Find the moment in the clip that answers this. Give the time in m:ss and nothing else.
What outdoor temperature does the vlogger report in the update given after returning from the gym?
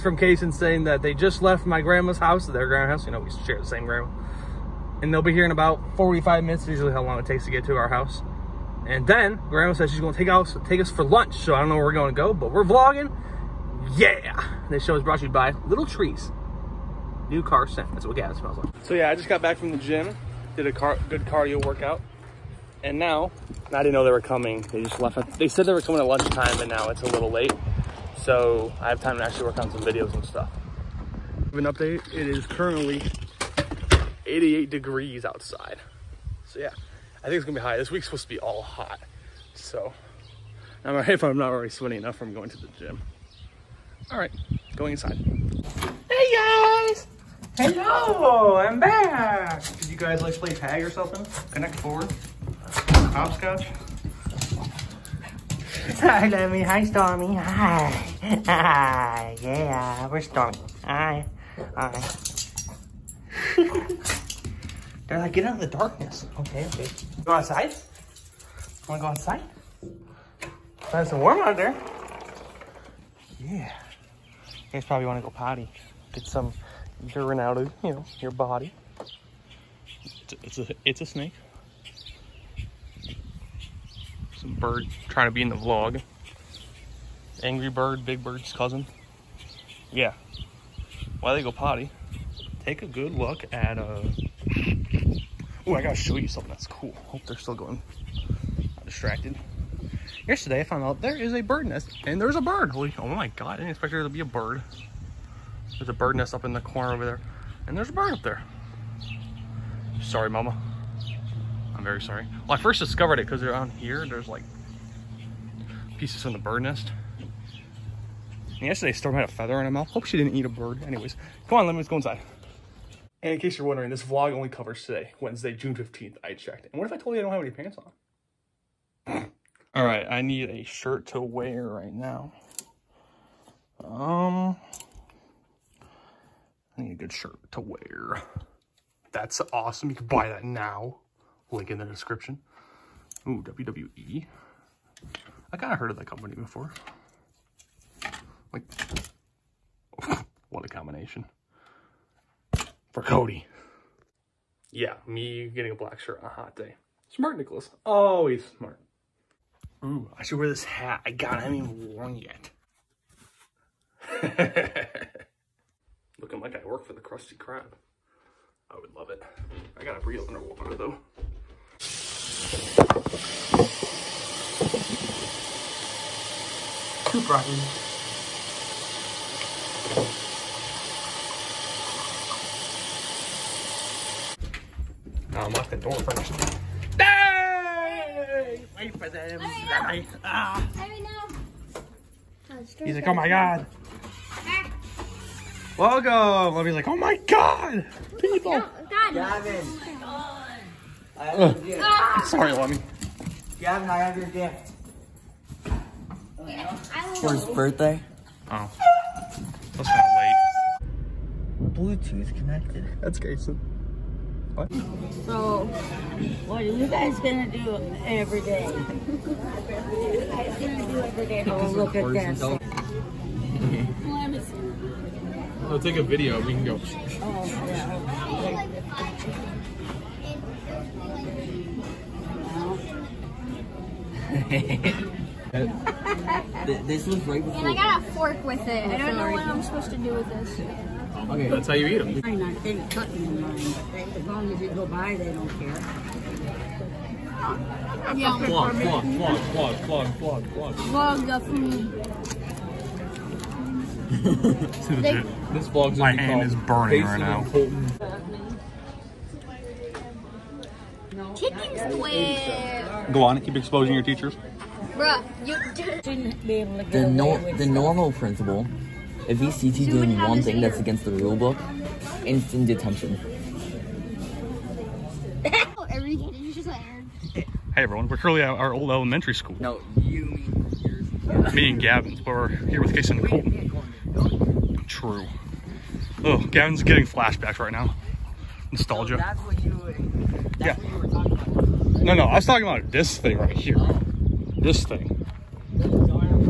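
0:34.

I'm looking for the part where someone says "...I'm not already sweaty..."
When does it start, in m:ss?
0:41.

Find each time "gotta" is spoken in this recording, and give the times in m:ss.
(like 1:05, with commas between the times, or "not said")
1:35, 2:49.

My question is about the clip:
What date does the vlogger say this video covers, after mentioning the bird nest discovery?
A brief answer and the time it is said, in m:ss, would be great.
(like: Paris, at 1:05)
Wednesday, June 15th, at 2:05.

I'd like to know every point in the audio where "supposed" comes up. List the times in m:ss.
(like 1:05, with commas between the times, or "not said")
0:38, 3:59.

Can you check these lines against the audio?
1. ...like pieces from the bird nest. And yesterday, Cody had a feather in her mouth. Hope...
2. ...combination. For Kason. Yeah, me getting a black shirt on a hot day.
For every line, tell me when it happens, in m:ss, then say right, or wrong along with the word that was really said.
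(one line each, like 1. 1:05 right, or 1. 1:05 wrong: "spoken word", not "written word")
1. 1:54 wrong: "Storm", not "Cody"
2. 2:30 wrong: "Cody", not "Kason".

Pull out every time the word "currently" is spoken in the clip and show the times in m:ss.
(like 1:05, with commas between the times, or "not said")
0:32, 4:38.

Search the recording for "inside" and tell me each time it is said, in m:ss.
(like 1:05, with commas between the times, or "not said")
0:44, 2:01.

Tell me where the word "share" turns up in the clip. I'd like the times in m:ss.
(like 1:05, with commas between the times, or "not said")
0:03.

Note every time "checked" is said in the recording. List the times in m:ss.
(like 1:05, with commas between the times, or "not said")
2:06.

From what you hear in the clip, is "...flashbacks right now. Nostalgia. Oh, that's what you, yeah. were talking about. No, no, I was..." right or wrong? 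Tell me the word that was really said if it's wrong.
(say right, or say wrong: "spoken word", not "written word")
right.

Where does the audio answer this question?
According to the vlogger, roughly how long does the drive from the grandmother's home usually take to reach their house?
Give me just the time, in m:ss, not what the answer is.
0:05.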